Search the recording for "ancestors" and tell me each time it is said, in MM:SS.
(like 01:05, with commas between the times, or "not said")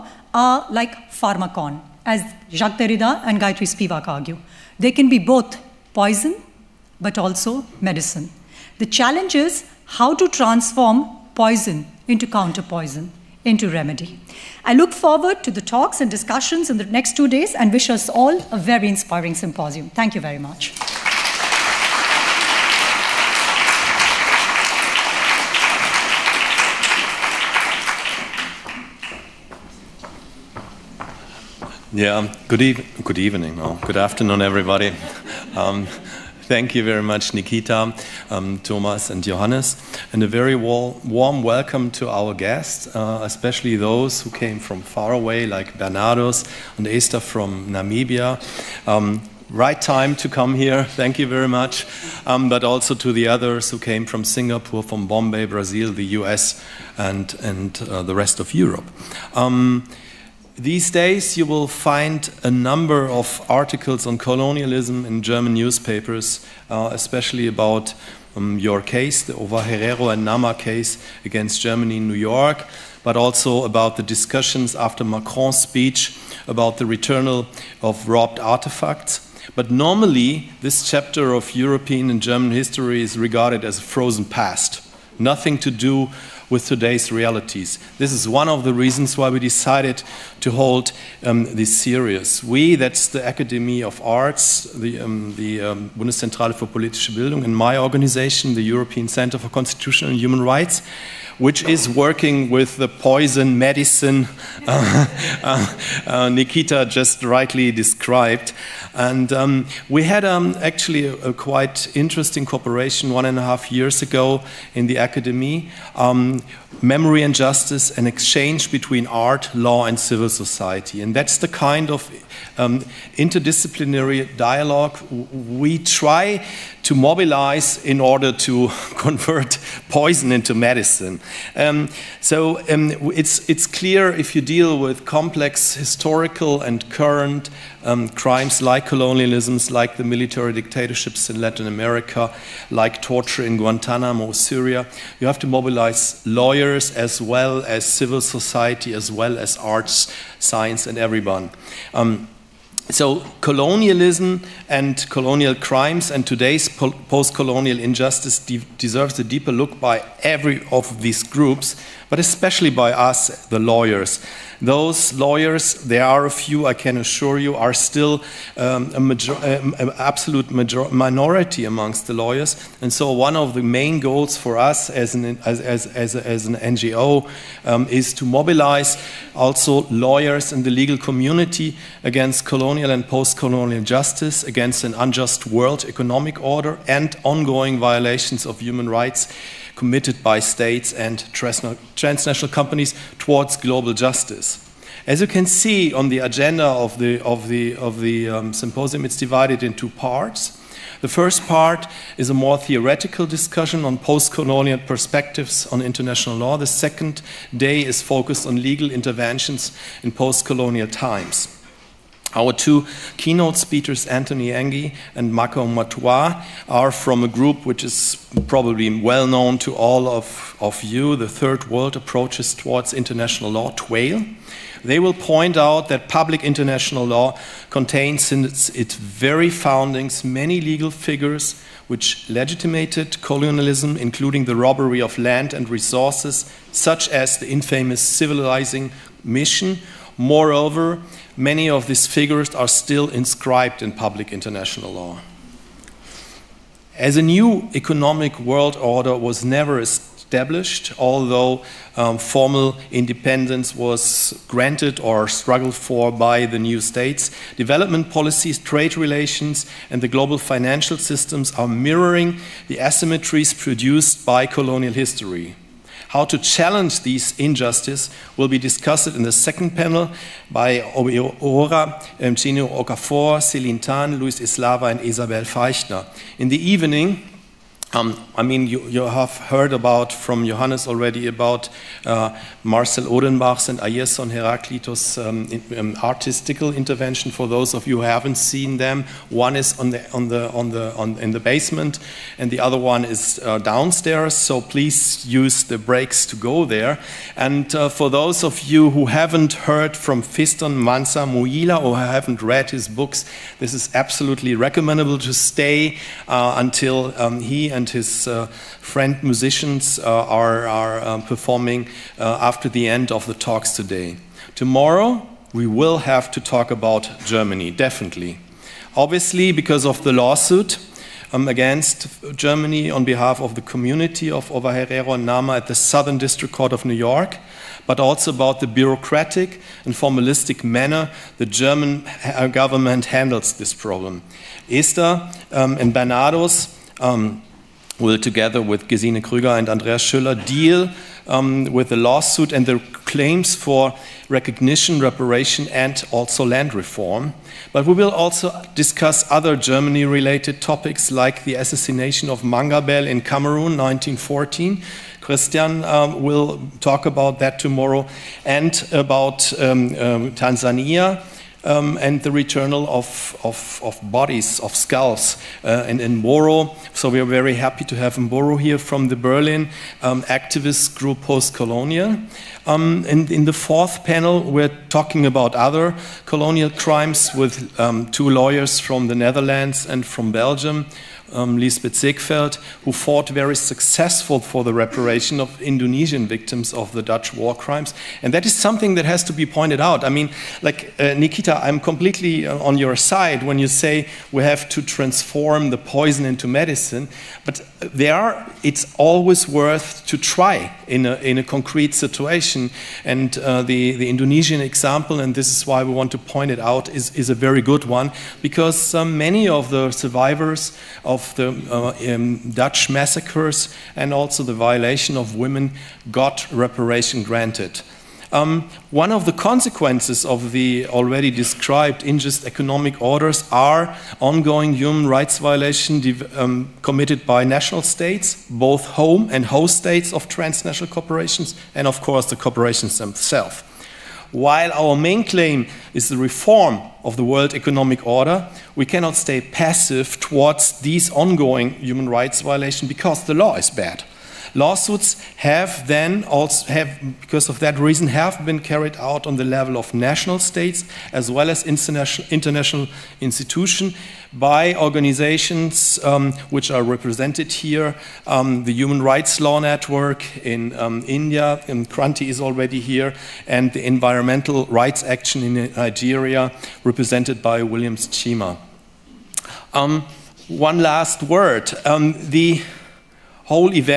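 not said.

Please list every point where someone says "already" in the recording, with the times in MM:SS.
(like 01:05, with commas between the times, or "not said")
04:40, 07:00, 07:42.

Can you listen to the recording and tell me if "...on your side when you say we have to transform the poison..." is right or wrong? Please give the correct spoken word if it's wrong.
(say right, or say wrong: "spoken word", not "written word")
right.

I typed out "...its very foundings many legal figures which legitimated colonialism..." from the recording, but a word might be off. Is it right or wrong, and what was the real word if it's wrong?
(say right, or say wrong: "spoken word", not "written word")
right.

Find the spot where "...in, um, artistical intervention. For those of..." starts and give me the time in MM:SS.
04:45.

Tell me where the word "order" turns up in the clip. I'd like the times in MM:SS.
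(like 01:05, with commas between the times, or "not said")
02:07, 03:06, 04:08, 07:02, 07:18.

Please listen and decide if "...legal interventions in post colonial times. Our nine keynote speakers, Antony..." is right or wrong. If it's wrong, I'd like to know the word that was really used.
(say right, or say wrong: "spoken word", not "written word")
wrong: "two", not "nine".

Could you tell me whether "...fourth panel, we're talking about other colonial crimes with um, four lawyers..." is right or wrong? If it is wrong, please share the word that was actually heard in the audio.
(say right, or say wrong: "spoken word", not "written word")
wrong: "two", not "four".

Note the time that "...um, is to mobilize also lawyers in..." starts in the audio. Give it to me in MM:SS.
02:57.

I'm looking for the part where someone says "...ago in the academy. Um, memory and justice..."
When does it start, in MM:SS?
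01:53.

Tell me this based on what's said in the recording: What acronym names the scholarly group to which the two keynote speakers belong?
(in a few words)
TWAIL.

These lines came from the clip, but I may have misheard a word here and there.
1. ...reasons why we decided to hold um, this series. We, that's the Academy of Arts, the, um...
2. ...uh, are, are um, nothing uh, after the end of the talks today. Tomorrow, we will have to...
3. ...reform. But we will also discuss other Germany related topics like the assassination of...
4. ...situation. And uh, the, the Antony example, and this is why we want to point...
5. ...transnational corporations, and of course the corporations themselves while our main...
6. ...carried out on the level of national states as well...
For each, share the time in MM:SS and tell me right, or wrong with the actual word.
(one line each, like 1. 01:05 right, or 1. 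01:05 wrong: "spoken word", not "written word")
1. 01:28 right
2. 05:09 wrong: "performing", not "nothing"
3. 05:46 right
4. 06:41 wrong: "Indonesian", not "Antony"
5. 07:10 right
6. 07:28 right.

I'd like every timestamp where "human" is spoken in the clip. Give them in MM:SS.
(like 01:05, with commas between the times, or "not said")
01:40, 03:08, 07:04, 07:21, 07:38.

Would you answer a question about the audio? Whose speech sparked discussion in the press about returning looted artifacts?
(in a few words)
Macron.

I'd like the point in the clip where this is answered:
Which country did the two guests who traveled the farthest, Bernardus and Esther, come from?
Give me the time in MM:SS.
00:47.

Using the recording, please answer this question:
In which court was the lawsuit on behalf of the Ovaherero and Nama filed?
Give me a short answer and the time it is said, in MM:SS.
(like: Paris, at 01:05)
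Southern District Court of New York, at 05:25.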